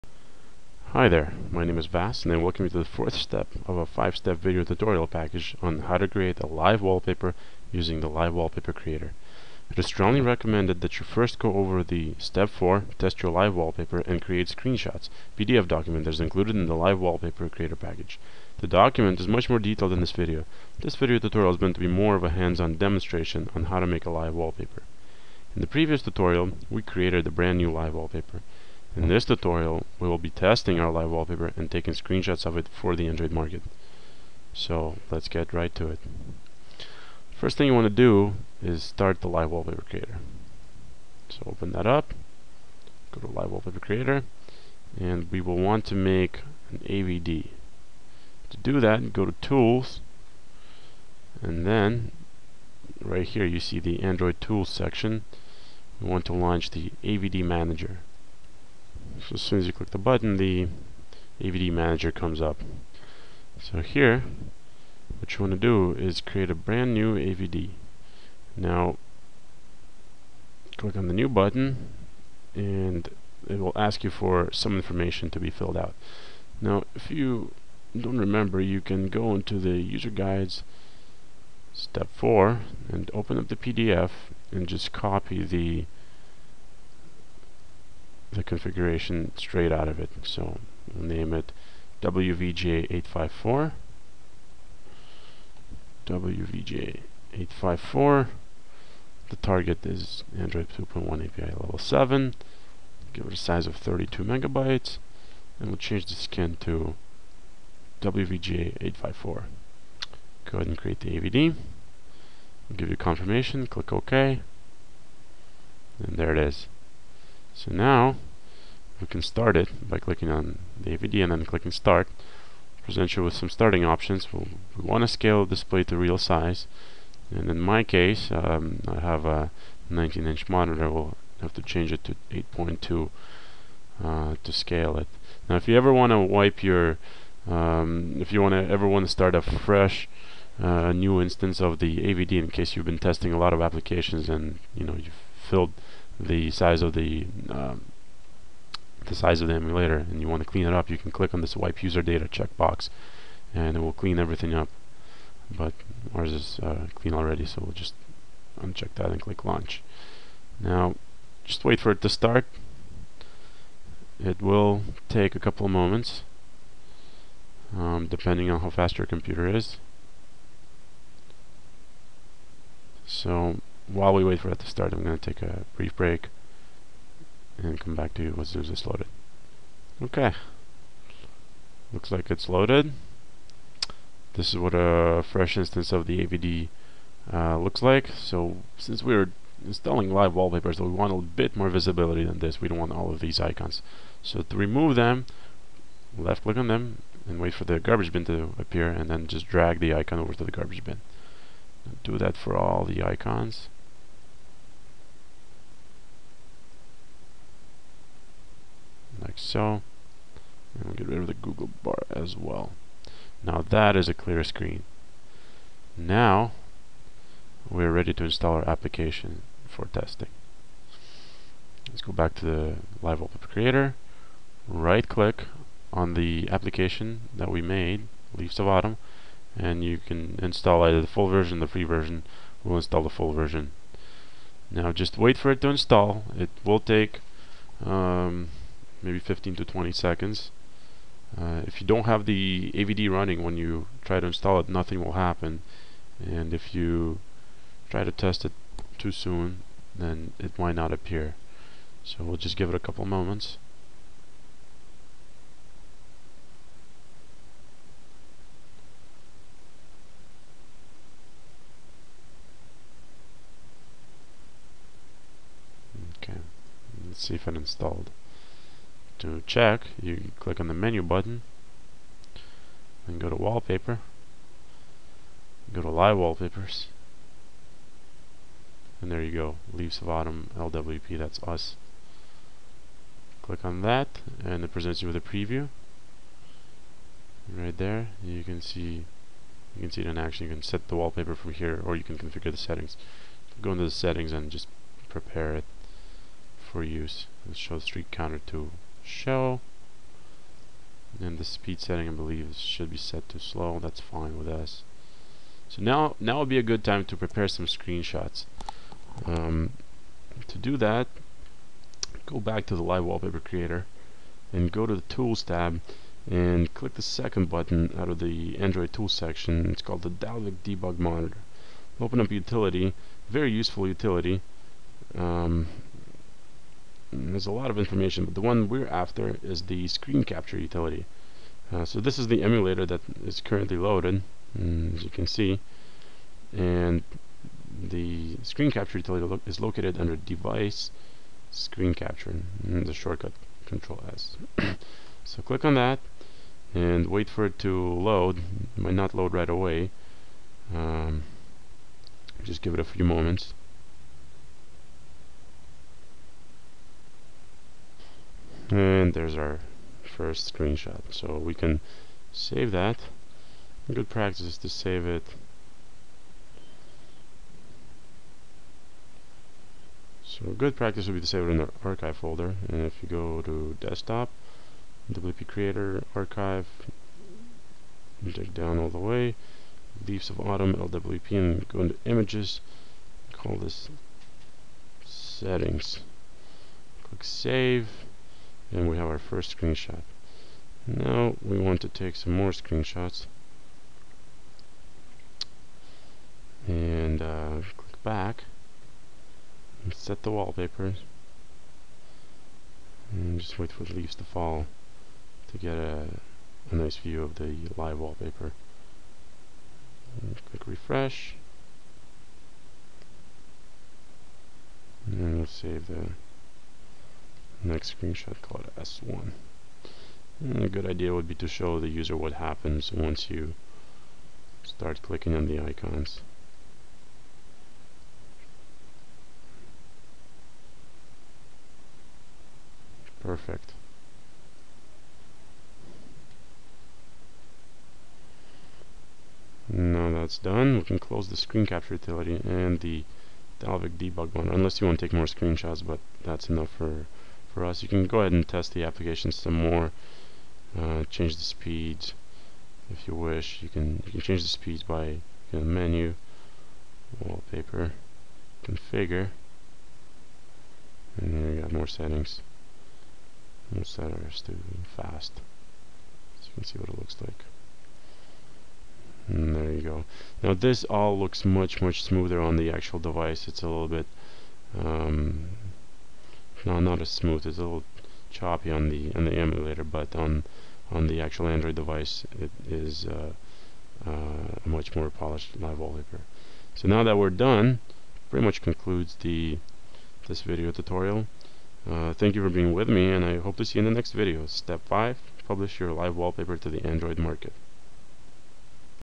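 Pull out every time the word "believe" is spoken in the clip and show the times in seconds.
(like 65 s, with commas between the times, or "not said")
302 s.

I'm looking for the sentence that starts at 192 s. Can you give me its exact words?
We don't want all of these icons.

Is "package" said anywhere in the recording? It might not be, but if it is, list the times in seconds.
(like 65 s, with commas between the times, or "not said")
5 s, 17 s.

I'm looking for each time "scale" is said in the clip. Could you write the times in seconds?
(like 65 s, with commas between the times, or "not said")
125 s, 134 s.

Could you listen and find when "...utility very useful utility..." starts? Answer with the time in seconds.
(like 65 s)
322 s.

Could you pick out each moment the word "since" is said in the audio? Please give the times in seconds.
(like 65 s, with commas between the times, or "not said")
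188 s.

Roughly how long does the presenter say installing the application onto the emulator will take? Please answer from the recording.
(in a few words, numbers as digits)
15 to 20 seconds.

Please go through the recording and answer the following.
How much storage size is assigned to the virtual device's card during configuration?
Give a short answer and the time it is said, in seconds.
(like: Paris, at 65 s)
32 megabytes, at 103 s.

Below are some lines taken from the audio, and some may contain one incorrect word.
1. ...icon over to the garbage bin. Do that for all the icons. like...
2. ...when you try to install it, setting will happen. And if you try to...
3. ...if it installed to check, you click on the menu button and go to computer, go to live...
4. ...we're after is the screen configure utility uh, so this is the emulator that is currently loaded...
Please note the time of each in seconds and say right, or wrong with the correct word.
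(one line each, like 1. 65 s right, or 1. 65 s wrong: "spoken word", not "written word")
1. 199 s right
2. 243 s wrong: "nothing", not "setting"
3. 267 s wrong: "wallpaper", not "computer"
4. 328 s wrong: "capture", not "configure".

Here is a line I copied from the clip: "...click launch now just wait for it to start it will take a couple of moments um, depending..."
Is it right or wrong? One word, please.
right.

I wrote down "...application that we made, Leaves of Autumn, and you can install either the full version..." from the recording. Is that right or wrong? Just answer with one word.
right.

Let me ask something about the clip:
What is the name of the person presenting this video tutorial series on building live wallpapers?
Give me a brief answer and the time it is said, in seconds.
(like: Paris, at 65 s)
Vass, at 1 s.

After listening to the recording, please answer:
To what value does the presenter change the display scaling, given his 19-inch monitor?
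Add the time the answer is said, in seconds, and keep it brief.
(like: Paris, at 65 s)
8.2, at 132 s.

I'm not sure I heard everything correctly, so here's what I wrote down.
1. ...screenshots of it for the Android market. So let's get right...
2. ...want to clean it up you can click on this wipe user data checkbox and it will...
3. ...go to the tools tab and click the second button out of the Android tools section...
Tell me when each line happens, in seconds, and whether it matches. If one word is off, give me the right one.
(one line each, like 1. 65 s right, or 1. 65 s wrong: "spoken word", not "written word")
1. 31 s right
2. 150 s right
3. 314 s right.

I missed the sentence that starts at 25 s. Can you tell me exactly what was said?
In the previous tutorial, we created a brand new live wallpaper.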